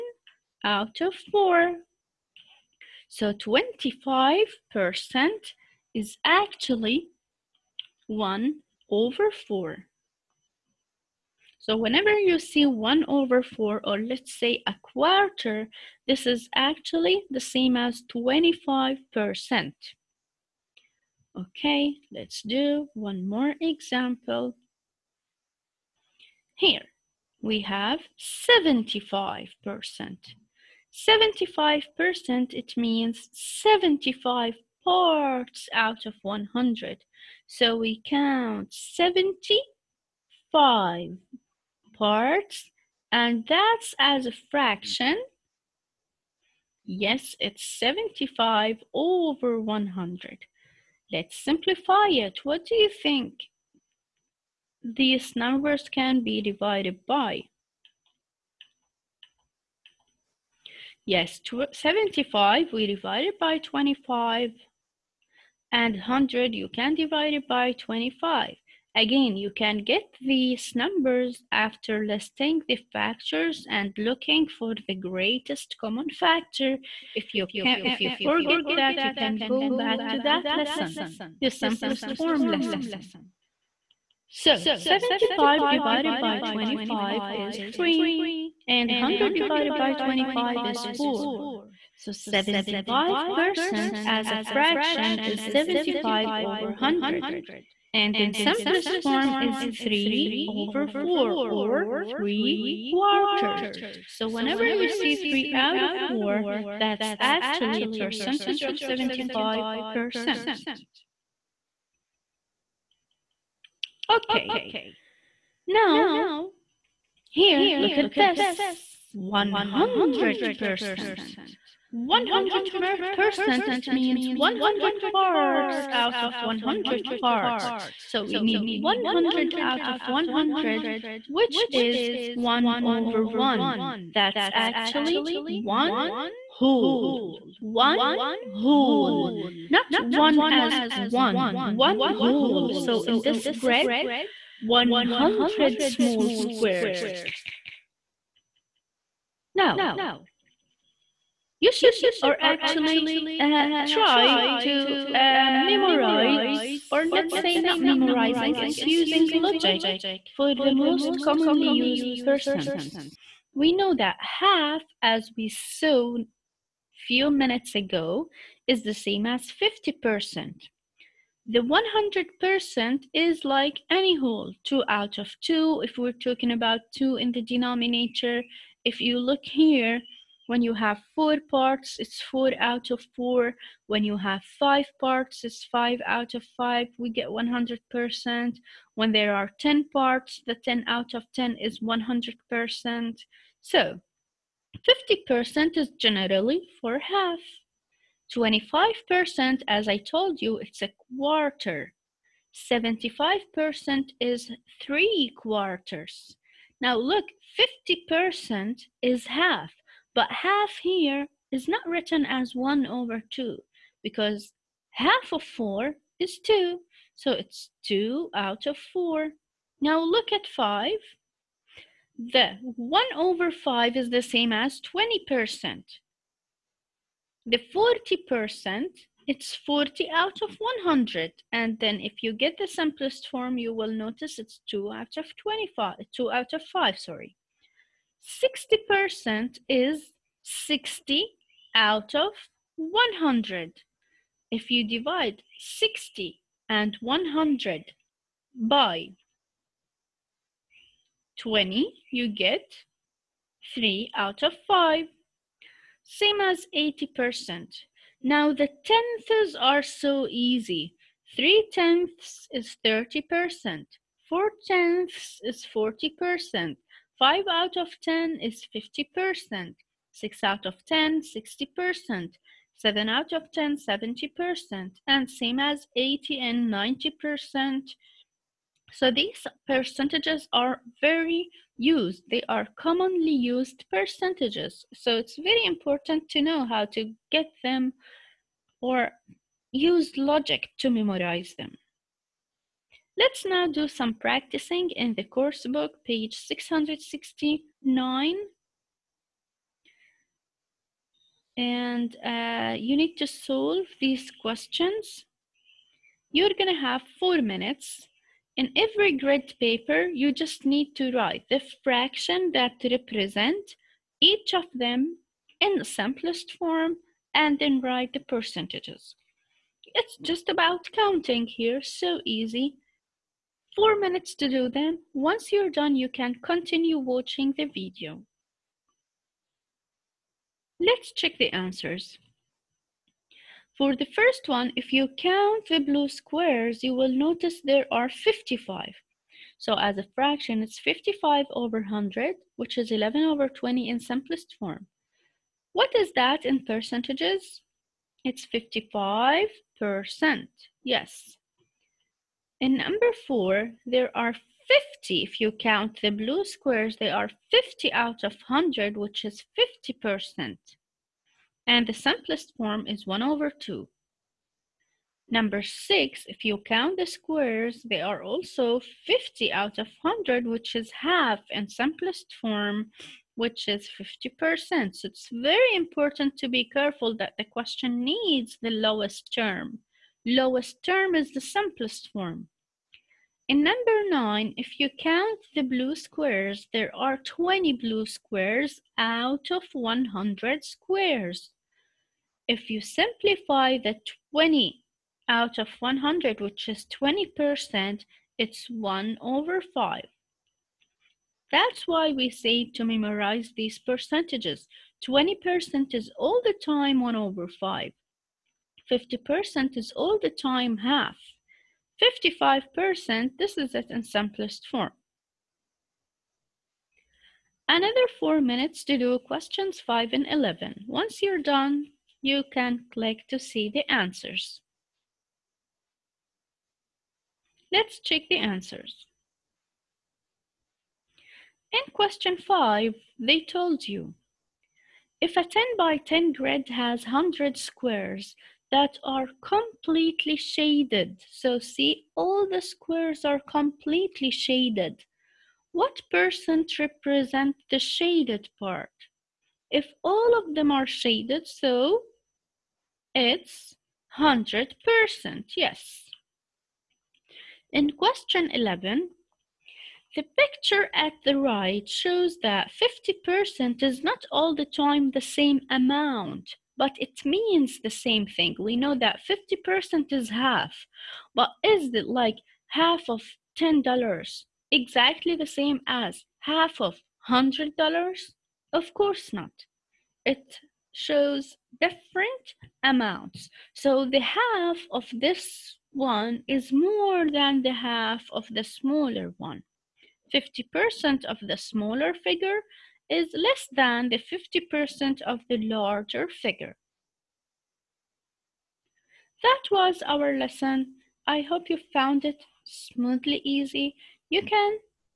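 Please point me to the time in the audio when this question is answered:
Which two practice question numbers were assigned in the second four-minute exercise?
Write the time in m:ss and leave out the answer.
6:59.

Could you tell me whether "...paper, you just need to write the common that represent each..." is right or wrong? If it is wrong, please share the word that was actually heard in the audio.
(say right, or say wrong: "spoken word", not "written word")
wrong: "fraction", not "common".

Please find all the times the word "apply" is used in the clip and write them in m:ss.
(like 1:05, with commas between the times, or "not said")
not said.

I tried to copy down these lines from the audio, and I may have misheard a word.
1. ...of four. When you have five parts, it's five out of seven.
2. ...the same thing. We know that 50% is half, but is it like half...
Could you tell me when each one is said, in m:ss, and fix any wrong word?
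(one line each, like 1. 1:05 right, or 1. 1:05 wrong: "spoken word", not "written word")
1. 3:02 wrong: "five", not "seven"
2. 7:47 right.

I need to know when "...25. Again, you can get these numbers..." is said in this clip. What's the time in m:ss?
1:07.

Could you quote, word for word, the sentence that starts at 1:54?
Okay, now here, look at this, 100%.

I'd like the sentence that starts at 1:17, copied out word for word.
If you, can, if you forget that, you can go back to that lesson, the simplest form lesson.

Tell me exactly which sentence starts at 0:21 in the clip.
Okay, let's do one more example.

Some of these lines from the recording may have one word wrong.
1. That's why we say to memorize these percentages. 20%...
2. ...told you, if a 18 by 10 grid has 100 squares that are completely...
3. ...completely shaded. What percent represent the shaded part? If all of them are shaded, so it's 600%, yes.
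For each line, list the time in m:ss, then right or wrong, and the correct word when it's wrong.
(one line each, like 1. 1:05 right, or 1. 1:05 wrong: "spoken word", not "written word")
1. 6:41 right
2. 7:13 wrong: "10", not "18"
3. 7:23 wrong: "100", not "600".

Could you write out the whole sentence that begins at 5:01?
And uh, you need to solve these questions.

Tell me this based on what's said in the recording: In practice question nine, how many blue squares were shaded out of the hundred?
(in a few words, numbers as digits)
20.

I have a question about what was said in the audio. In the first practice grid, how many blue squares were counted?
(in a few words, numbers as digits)
55.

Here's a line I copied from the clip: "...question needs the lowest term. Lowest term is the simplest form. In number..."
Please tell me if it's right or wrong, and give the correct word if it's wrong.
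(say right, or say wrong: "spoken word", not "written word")
right.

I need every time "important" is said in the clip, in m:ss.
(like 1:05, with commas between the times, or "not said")
4:45, 6:15.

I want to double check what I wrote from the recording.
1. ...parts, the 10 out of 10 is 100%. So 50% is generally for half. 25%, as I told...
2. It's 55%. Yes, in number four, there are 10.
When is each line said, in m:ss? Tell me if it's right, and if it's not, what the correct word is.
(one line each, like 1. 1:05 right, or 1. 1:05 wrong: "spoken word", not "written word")
1. 3:09 right
2. 5:48 wrong: "50", not "10".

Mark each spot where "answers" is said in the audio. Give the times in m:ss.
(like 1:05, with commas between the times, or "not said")
5:31, 7:03, 7:08.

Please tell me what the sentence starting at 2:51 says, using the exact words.
The 100% is like any whole, 2 out of 2, if we're talking about 2 in the denominator.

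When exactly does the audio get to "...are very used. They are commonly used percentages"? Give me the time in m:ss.
4:40.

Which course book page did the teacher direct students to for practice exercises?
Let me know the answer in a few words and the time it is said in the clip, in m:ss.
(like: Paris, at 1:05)
669, at 4:56.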